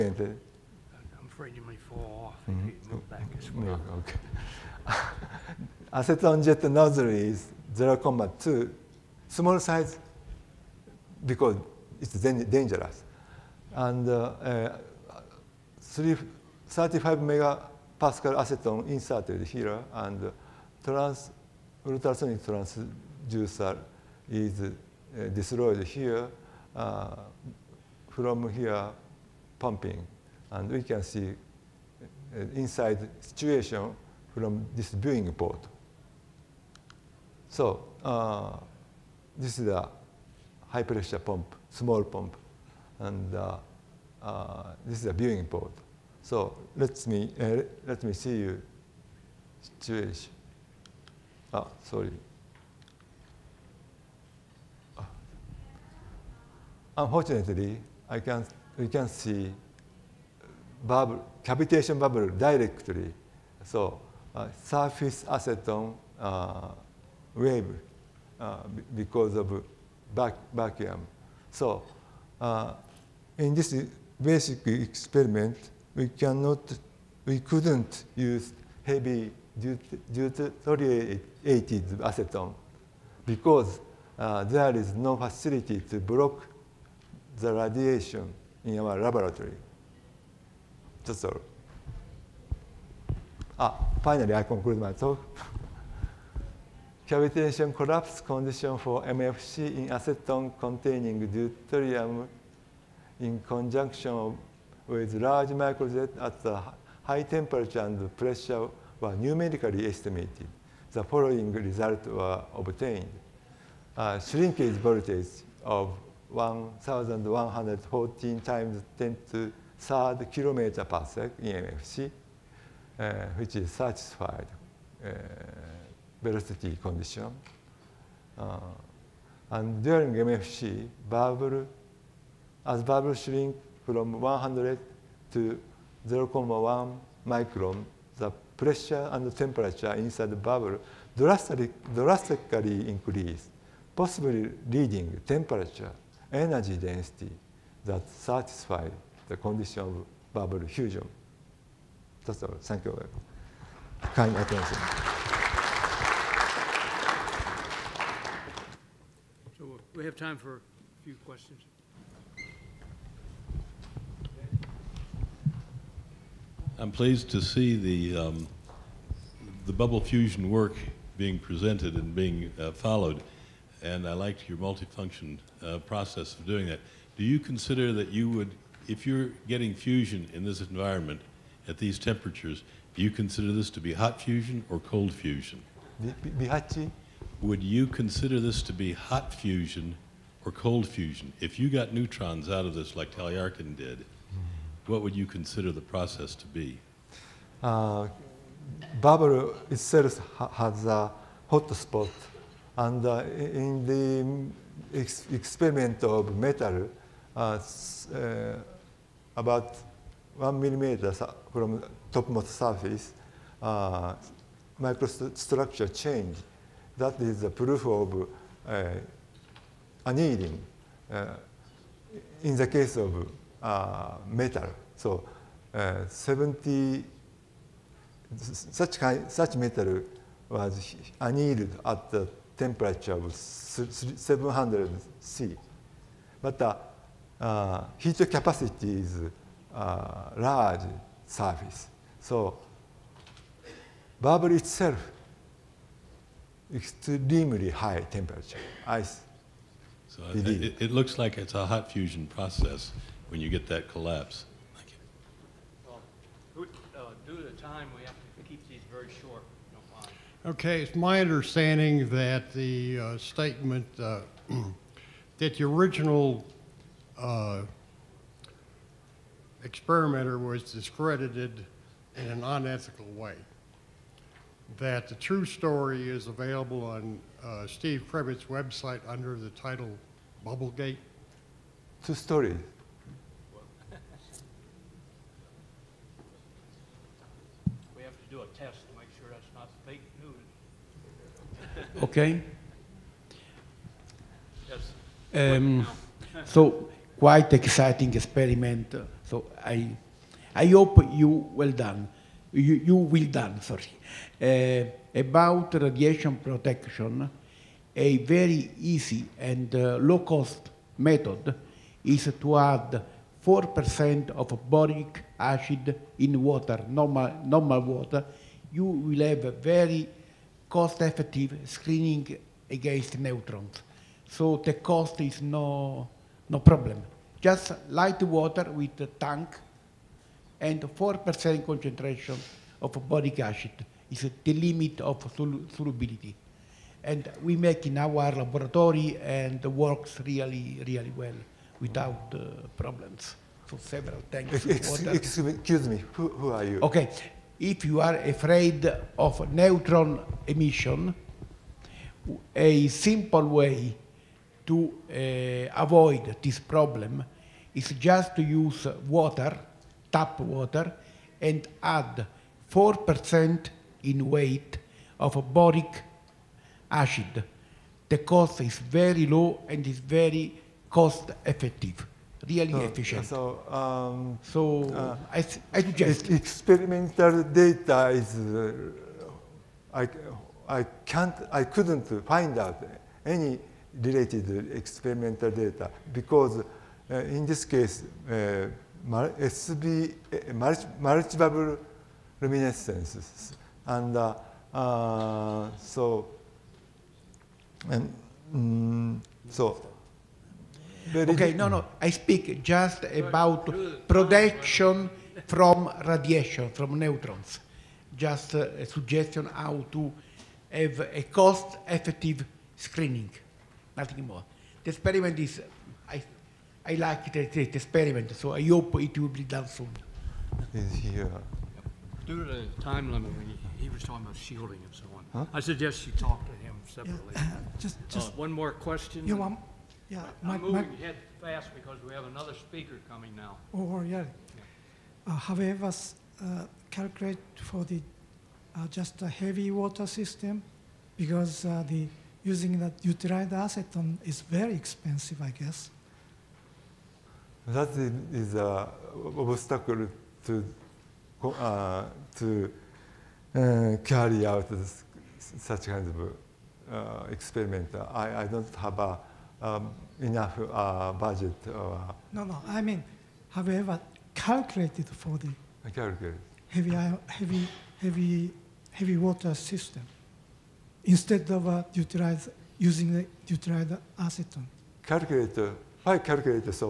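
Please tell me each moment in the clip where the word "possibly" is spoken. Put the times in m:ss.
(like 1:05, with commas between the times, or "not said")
2:23.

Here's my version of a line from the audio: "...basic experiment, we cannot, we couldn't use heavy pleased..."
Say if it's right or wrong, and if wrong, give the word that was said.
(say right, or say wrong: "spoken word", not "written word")
wrong: "deuterated", not "pleased".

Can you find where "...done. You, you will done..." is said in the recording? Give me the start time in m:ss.
5:01.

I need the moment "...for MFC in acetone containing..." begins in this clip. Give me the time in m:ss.
1:38.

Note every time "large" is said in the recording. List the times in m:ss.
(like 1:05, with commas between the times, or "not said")
1:45, 4:00.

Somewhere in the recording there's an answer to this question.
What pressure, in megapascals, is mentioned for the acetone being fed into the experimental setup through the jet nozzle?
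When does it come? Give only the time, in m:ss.
0:16.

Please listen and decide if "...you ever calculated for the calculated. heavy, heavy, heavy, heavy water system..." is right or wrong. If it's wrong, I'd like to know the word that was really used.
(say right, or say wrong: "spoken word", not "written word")
right.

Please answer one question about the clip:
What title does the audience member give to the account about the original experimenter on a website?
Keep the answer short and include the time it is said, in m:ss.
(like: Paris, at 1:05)
Bubblegate, at 4:40.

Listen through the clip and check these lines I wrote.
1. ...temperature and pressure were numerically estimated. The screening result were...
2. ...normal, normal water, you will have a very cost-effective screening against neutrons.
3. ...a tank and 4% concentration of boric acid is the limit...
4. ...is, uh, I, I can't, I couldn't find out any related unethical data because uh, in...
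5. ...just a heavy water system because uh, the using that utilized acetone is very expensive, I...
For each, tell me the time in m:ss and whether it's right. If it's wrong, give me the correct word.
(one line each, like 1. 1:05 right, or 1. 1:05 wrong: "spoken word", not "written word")
1. 1:47 wrong: "following", not "screening"
2. 5:16 right
3. 5:29 right
4. 6:18 wrong: "experimental", not "unethical"
5. 7:18 right.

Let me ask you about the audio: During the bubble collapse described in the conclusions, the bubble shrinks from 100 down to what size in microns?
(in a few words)
0.1 micron.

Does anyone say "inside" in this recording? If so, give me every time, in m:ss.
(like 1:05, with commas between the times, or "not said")
0:32, 2:19.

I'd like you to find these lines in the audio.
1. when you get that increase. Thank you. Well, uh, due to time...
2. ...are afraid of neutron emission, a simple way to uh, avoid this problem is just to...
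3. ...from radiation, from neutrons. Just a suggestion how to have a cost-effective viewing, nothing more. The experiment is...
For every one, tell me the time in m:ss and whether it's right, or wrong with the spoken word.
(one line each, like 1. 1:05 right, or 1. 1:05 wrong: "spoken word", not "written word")
1. 4:13 wrong: "collapse", not "increase"
2. 5:48 right
3. 6:45 wrong: "screening", not "viewing".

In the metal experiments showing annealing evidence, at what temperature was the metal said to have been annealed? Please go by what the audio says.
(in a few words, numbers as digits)
700 C.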